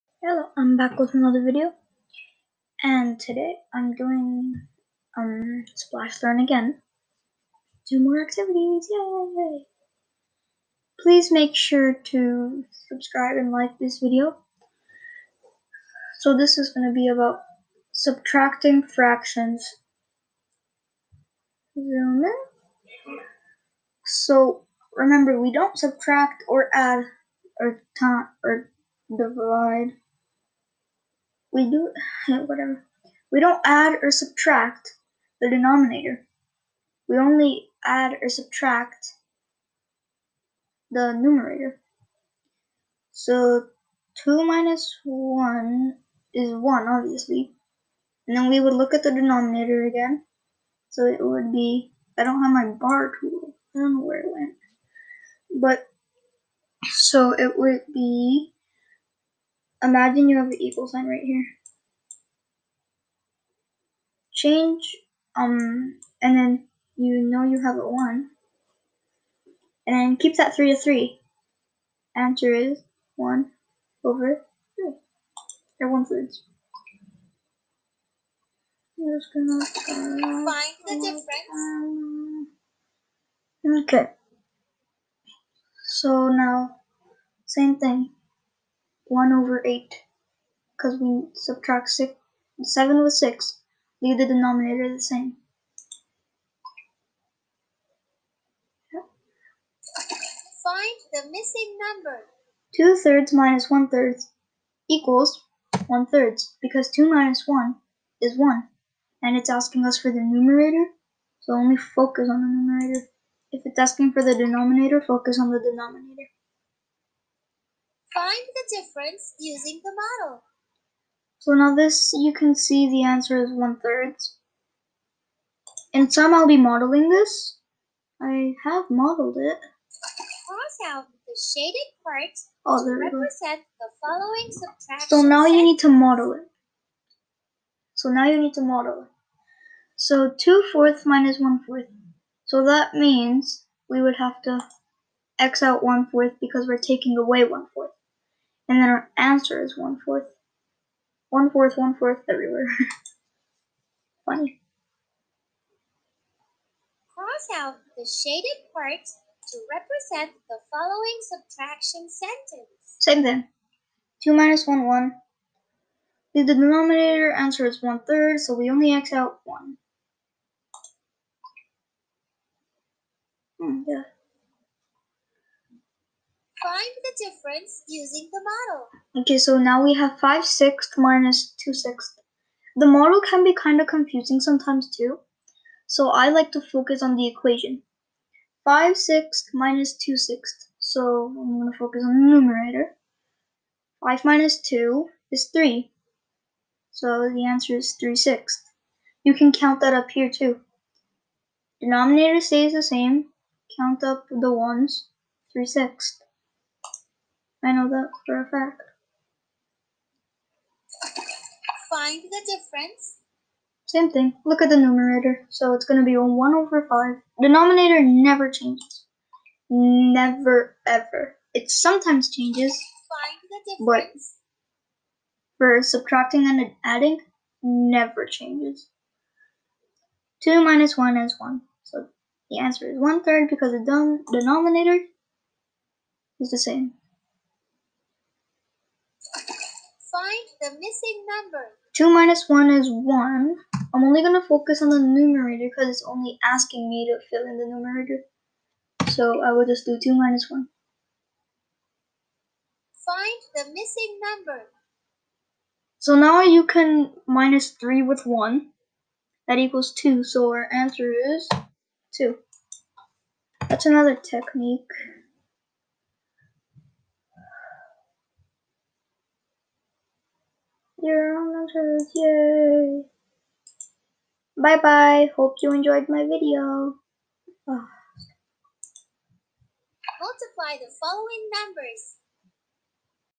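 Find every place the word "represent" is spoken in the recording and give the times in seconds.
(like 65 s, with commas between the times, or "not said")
133 s, 159 s.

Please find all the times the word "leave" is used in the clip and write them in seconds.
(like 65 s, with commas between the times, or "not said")
94 s.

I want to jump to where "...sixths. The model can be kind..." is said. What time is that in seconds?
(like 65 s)
181 s.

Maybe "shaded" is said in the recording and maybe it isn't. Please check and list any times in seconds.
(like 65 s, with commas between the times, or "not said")
131 s, 158 s.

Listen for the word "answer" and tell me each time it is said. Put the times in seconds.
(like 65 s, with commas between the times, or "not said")
72 s, 123 s, 149 s, 167 s, 197 s, 232 s, 260 s.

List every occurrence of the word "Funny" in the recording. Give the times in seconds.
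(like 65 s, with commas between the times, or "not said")
154 s.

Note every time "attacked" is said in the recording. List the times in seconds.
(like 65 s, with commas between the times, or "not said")
not said.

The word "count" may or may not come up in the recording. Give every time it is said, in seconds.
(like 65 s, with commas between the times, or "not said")
199 s, 203 s.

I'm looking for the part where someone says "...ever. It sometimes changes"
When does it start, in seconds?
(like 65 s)
220 s.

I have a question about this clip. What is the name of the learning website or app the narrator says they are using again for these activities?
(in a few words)
Splash Learn.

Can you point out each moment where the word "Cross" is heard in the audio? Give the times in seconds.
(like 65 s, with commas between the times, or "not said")
130 s, 157 s.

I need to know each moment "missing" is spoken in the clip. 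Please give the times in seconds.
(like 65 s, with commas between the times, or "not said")
101 s, 240 s, 253 s.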